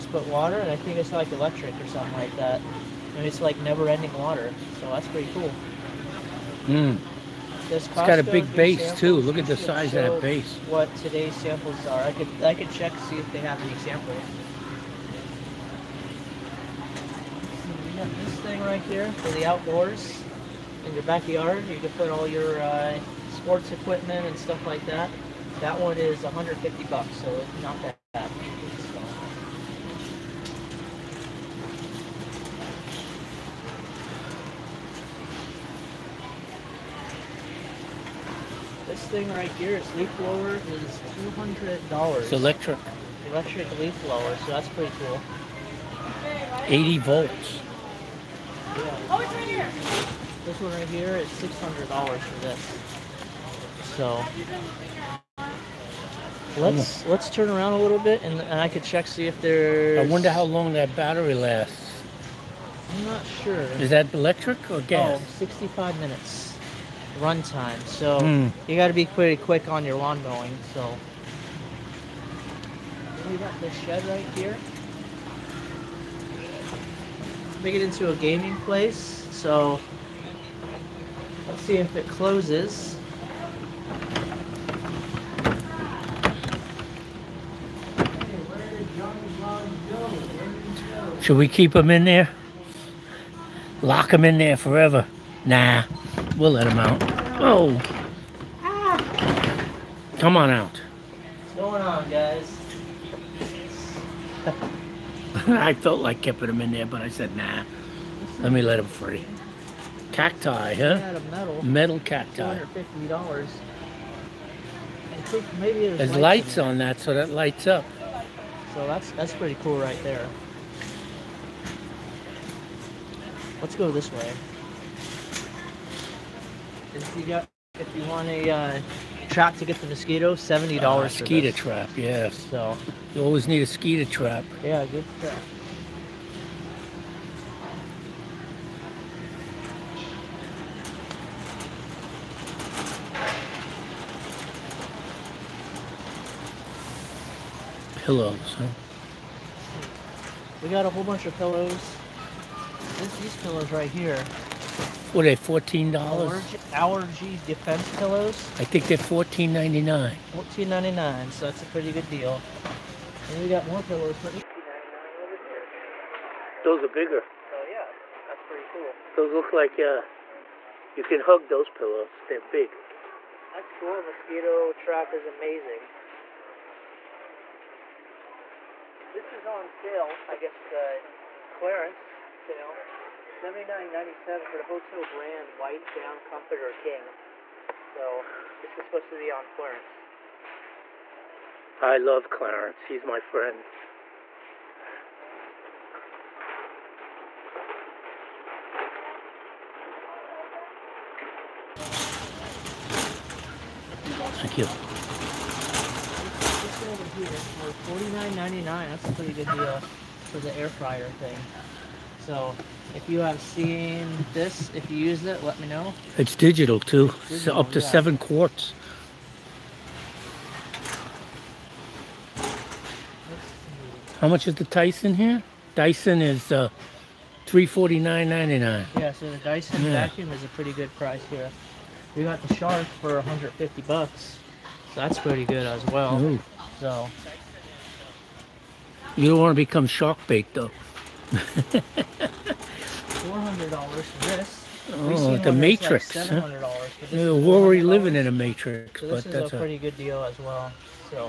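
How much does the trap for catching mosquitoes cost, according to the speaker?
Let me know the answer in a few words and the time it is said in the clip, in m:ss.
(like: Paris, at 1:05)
$70, at 2:10.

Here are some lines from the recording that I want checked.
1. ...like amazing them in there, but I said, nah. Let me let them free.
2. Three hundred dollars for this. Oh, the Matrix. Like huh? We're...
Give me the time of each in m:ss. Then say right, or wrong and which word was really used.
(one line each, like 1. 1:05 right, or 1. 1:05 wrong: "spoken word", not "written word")
1. 1:46 wrong: "keeping", not "amazing"
2. 4:03 wrong: "Four", not "Three".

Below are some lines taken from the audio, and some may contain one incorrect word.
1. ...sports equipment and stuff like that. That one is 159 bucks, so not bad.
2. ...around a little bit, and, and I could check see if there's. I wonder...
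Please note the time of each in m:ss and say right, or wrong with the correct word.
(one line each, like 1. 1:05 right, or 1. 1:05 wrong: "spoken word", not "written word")
1. 0:23 wrong: "150", not "159"
2. 0:57 right.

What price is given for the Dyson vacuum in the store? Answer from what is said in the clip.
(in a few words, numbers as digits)
$349.99.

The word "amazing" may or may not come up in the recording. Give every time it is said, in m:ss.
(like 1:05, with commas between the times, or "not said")
2:55.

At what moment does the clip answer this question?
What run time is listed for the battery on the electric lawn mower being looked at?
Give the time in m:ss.
1:05.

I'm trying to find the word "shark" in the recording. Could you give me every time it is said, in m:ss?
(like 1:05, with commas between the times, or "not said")
3:52, 3:59.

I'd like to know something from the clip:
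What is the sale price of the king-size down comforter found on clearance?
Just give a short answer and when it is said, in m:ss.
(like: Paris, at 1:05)
$79.97, at 3:03.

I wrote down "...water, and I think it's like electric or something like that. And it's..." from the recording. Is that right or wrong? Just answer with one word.
right.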